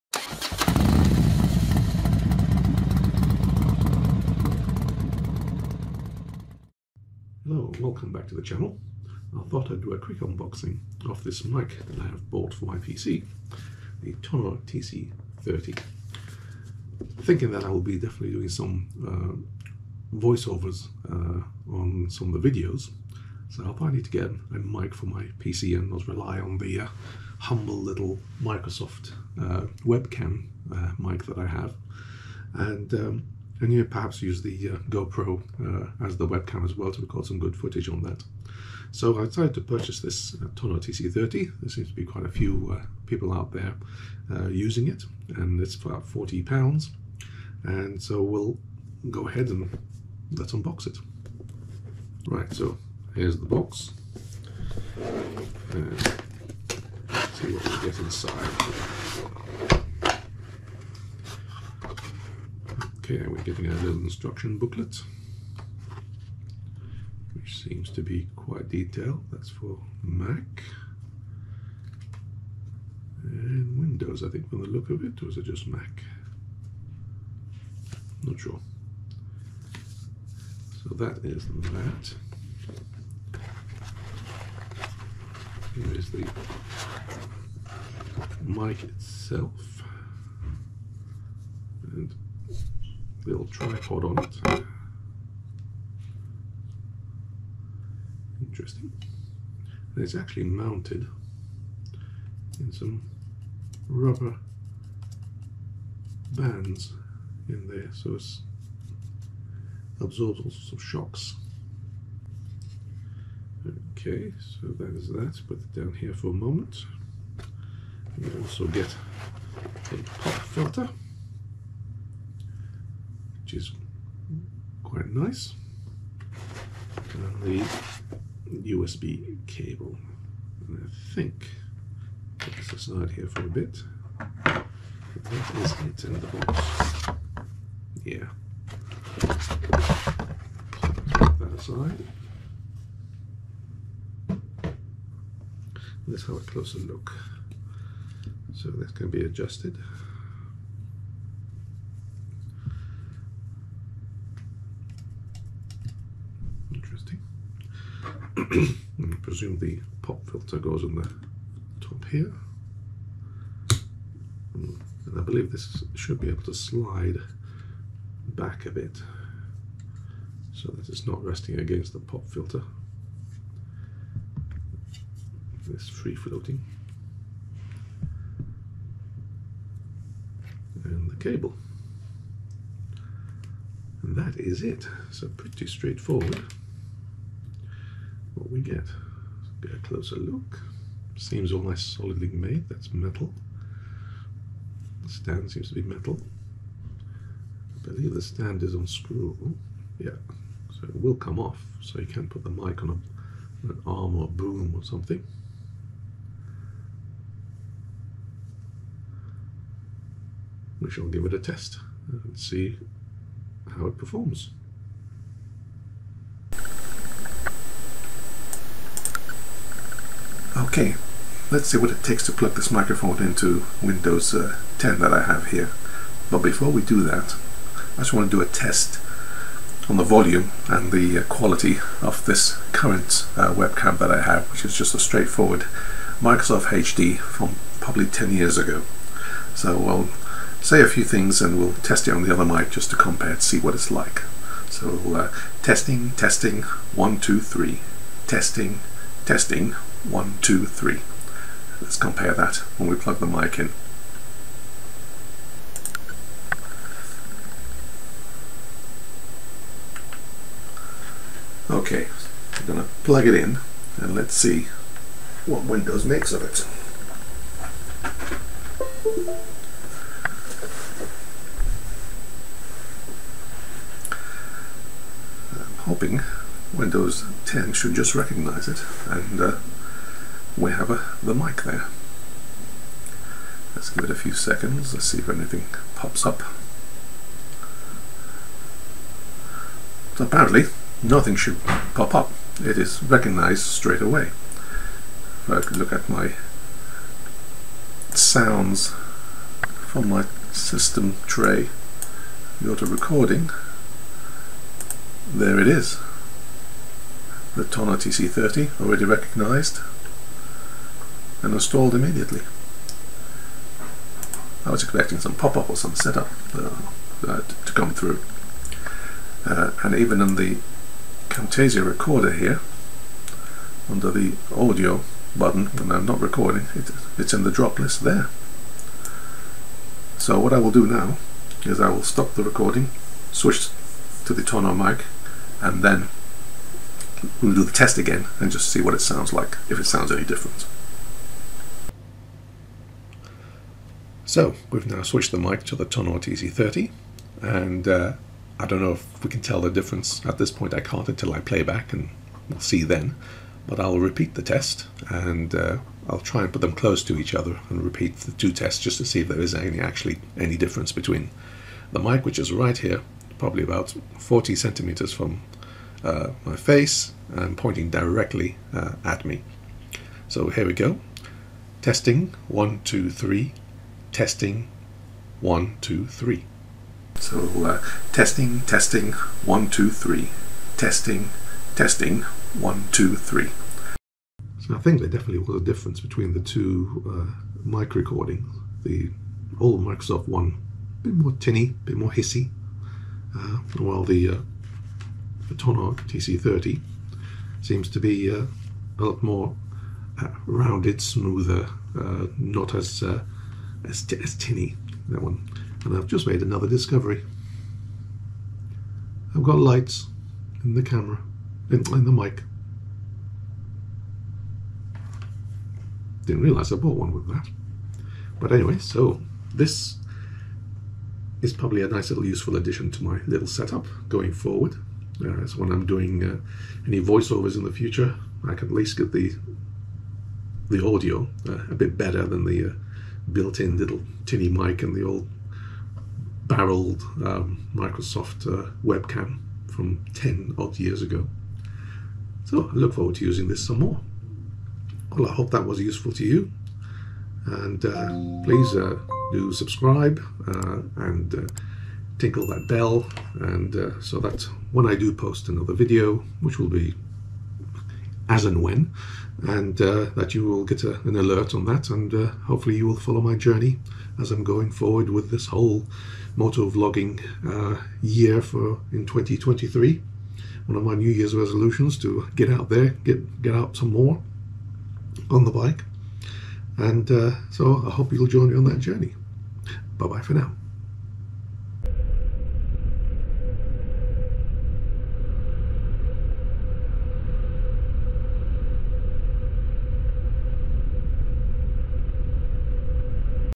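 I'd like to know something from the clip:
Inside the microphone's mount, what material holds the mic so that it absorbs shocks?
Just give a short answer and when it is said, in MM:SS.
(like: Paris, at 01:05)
rubber bands, at 01:43.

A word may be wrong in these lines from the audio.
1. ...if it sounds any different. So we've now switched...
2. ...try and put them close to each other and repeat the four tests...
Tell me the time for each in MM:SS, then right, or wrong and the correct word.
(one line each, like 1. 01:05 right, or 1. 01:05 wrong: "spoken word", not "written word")
1. 05:39 right
2. 05:56 wrong: "two", not "four".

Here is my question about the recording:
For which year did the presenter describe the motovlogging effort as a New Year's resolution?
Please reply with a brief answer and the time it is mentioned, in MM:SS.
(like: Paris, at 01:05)
2023, at 07:49.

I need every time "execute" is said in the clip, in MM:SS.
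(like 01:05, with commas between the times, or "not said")
not said.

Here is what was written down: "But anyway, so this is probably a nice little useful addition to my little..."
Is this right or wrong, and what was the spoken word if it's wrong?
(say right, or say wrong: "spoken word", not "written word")
right.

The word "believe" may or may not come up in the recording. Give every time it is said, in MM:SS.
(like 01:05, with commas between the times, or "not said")
02:45, 03:17.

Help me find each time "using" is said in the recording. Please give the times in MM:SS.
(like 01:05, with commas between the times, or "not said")
00:44, 07:23.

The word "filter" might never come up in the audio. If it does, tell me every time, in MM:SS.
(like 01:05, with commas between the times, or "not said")
02:00, 02:40, 02:52.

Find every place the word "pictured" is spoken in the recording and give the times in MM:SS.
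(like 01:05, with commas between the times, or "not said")
not said.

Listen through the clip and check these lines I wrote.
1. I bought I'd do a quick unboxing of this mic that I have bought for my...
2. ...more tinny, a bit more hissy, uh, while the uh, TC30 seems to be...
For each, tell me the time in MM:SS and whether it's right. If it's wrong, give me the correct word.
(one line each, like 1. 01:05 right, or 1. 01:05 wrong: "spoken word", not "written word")
1. 00:09 wrong: "thought", not "bought"
2. 06:31 right.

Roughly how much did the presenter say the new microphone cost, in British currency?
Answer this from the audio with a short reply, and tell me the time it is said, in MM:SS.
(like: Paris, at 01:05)
40 pounds, at 00:46.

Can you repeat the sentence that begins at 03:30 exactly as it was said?
We shall give it a test and see how it performs.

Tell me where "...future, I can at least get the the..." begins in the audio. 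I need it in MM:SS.
07:07.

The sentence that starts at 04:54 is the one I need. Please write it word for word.
If I could look at my sounds from my system tray, go a recording, there it is.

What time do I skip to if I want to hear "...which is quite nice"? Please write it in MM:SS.
02:03.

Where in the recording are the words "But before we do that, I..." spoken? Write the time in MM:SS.
03:46.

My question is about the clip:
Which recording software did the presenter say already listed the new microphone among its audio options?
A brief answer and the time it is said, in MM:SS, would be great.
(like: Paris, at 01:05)
Camtasia, at 05:21.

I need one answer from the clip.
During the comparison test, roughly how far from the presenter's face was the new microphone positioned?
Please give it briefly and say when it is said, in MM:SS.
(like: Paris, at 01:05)
40 centimeters, at 06:04.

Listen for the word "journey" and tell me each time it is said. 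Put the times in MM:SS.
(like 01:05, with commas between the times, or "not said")
07:43, 07:58.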